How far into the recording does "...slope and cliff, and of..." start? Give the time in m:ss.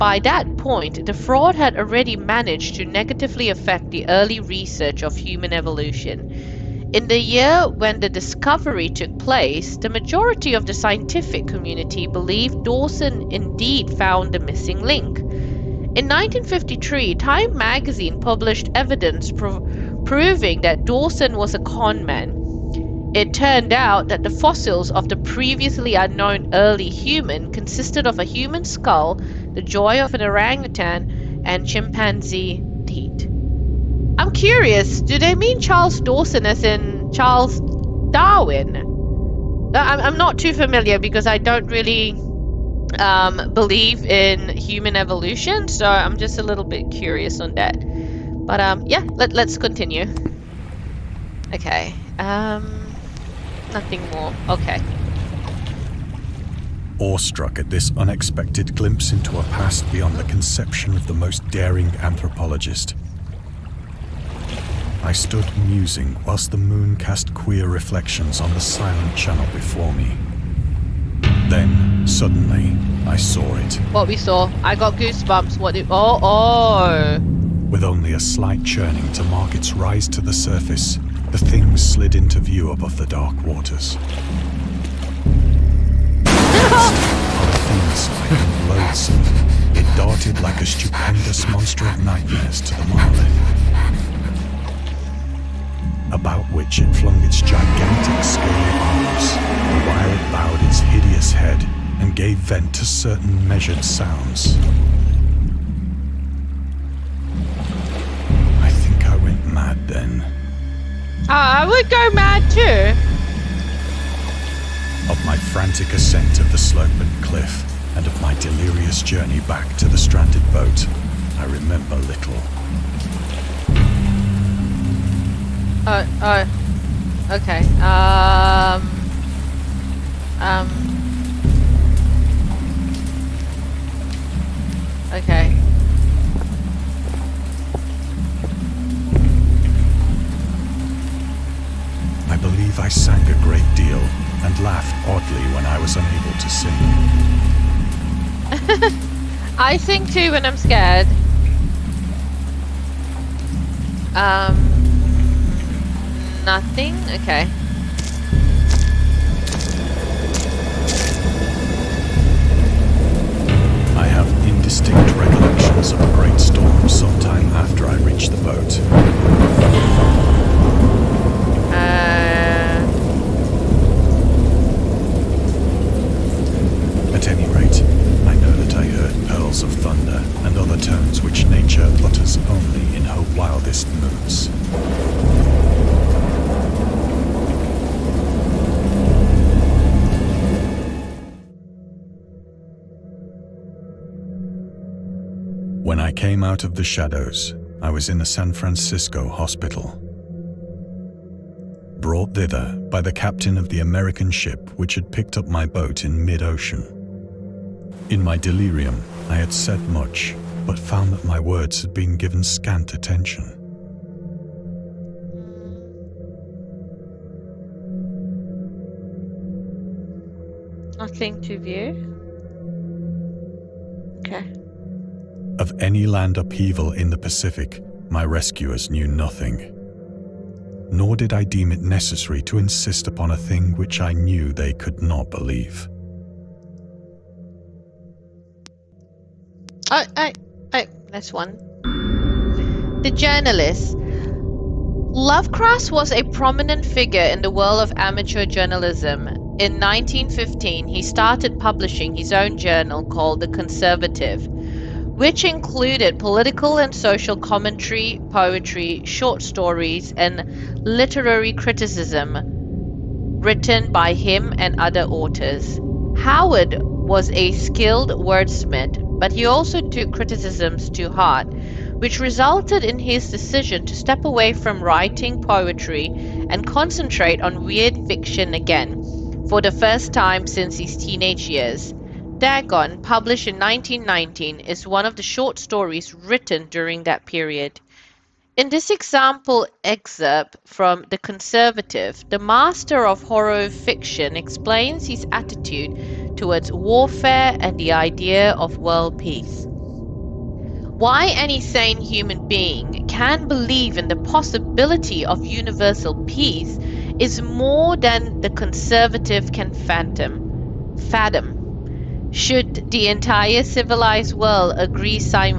1:56.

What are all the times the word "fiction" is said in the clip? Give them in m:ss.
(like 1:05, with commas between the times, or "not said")
4:38, 4:53.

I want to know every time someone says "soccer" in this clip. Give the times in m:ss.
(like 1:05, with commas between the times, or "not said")
not said.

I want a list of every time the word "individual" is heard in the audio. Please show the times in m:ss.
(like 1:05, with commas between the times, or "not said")
not said.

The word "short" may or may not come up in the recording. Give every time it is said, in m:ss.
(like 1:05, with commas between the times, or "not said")
4:19, 4:45.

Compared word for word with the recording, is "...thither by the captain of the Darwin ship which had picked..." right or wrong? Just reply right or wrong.
wrong.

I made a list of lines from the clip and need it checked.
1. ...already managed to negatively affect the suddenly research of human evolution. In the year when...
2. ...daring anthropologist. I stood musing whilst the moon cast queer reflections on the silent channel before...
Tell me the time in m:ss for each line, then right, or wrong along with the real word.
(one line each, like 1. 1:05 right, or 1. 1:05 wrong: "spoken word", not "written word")
1. 0:01 wrong: "early", not "suddenly"
2. 1:01 right.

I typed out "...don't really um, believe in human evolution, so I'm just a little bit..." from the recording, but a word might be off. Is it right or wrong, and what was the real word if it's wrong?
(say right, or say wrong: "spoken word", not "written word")
right.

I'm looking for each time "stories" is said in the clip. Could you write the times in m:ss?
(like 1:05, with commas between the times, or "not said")
4:19, 4:45.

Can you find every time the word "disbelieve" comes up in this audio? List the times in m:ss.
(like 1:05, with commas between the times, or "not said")
not said.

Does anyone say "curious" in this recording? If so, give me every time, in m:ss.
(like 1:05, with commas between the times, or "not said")
0:34, 0:46.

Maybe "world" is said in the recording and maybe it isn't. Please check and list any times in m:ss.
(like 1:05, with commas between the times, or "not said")
4:07, 4:58, 5:14.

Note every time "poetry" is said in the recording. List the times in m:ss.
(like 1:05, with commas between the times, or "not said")
4:18, 4:35.